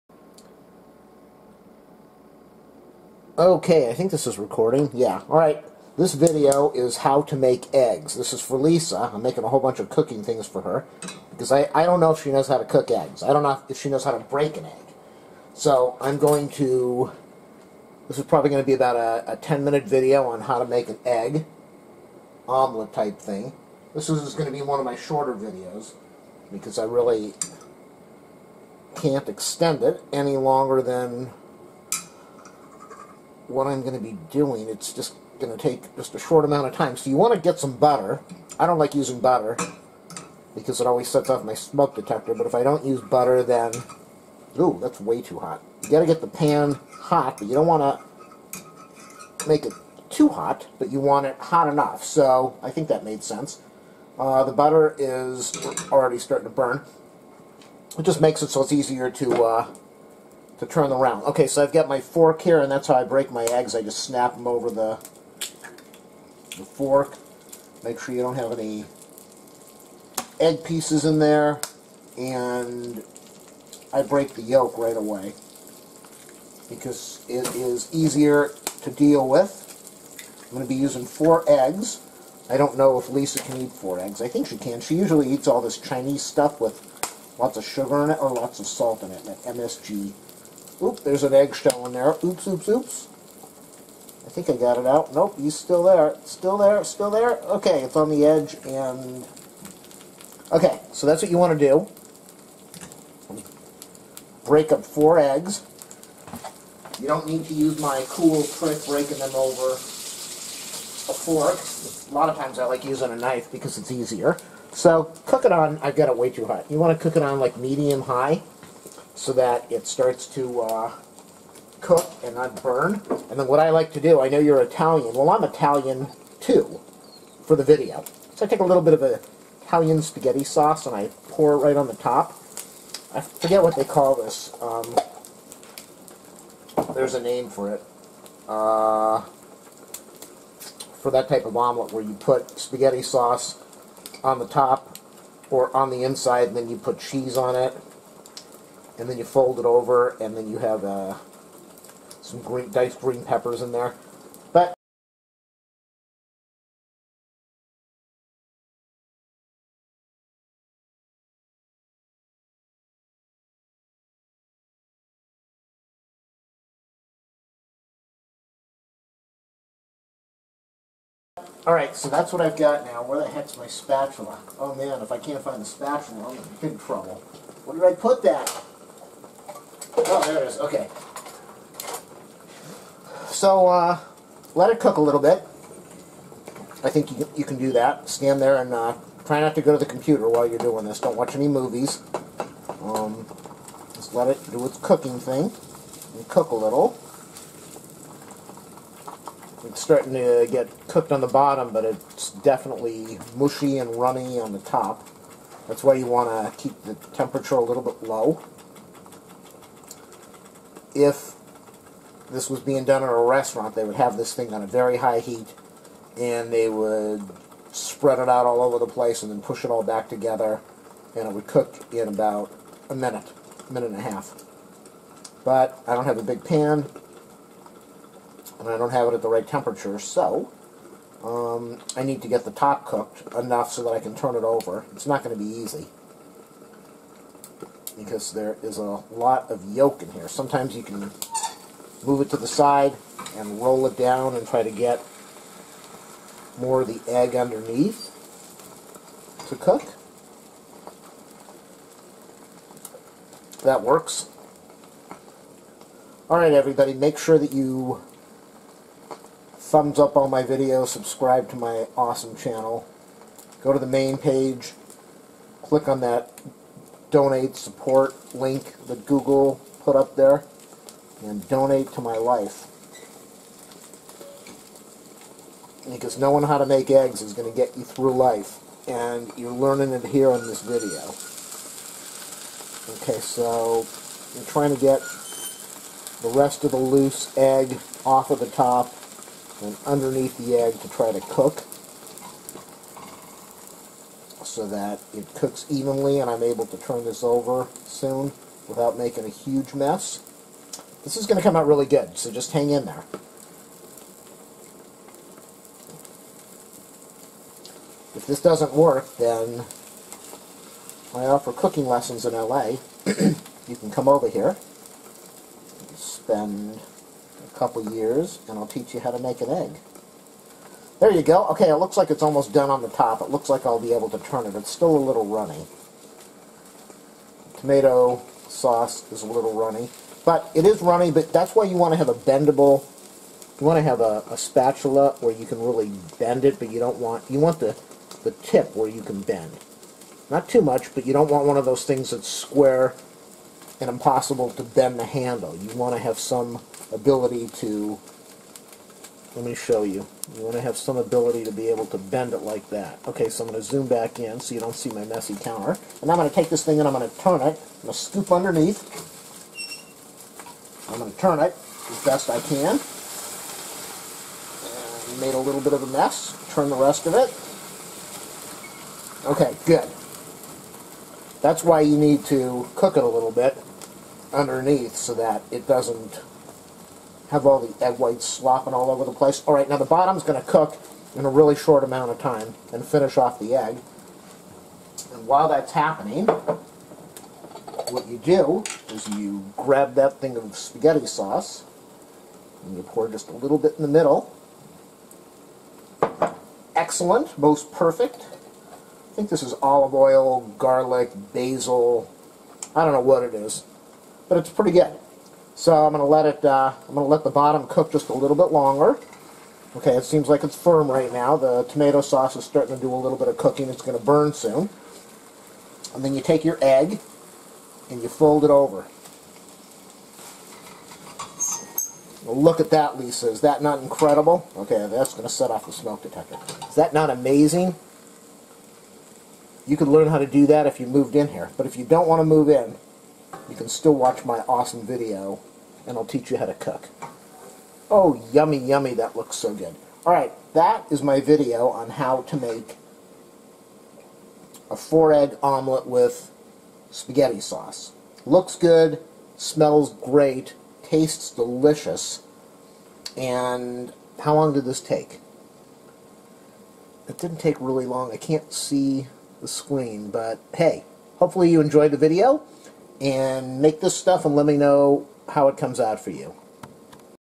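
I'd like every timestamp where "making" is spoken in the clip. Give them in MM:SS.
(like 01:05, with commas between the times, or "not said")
00:09, 04:58.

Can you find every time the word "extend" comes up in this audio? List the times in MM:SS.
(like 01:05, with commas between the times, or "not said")
00:29.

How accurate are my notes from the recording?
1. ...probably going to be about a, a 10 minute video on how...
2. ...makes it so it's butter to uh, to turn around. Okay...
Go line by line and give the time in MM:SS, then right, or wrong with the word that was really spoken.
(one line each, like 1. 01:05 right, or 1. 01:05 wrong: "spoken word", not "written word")
1. 00:18 right
2. 00:58 wrong: "easier", not "butter".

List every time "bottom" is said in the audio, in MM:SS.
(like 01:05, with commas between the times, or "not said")
03:21, 06:19, 06:47.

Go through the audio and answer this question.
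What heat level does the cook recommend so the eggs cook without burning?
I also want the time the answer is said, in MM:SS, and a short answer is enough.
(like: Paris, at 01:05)
medium high, at 01:57.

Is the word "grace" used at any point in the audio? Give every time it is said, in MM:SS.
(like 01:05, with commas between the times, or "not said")
not said.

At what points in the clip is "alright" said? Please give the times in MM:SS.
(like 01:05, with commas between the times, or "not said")
00:05, 02:51, 04:16, 07:20.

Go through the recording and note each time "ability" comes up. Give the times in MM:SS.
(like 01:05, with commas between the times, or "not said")
05:46, 05:50.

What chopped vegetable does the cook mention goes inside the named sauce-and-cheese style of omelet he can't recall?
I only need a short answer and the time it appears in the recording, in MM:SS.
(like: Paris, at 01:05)
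diced green peppers, at 02:32.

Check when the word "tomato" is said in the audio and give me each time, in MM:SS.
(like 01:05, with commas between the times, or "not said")
05:27, 06:51.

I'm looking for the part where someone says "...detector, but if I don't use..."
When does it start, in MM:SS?
00:41.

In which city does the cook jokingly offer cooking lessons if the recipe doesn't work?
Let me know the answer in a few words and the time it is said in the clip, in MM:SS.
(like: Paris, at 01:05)
LA, at 05:12.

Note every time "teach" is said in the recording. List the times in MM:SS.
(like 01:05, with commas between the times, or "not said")
05:18, 07:16.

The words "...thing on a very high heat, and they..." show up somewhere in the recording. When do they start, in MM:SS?
03:34.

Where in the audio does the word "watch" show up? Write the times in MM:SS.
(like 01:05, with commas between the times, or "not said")
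03:11, 07:13.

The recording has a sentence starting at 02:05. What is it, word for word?
Well, I'm Italian too for the video.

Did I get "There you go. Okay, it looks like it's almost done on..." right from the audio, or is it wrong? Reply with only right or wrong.
right.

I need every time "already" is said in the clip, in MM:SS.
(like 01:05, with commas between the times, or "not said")
00:55.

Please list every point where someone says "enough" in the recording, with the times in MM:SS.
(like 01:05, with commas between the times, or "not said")
00:51, 03:53.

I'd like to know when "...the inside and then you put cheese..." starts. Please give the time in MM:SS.
02:25.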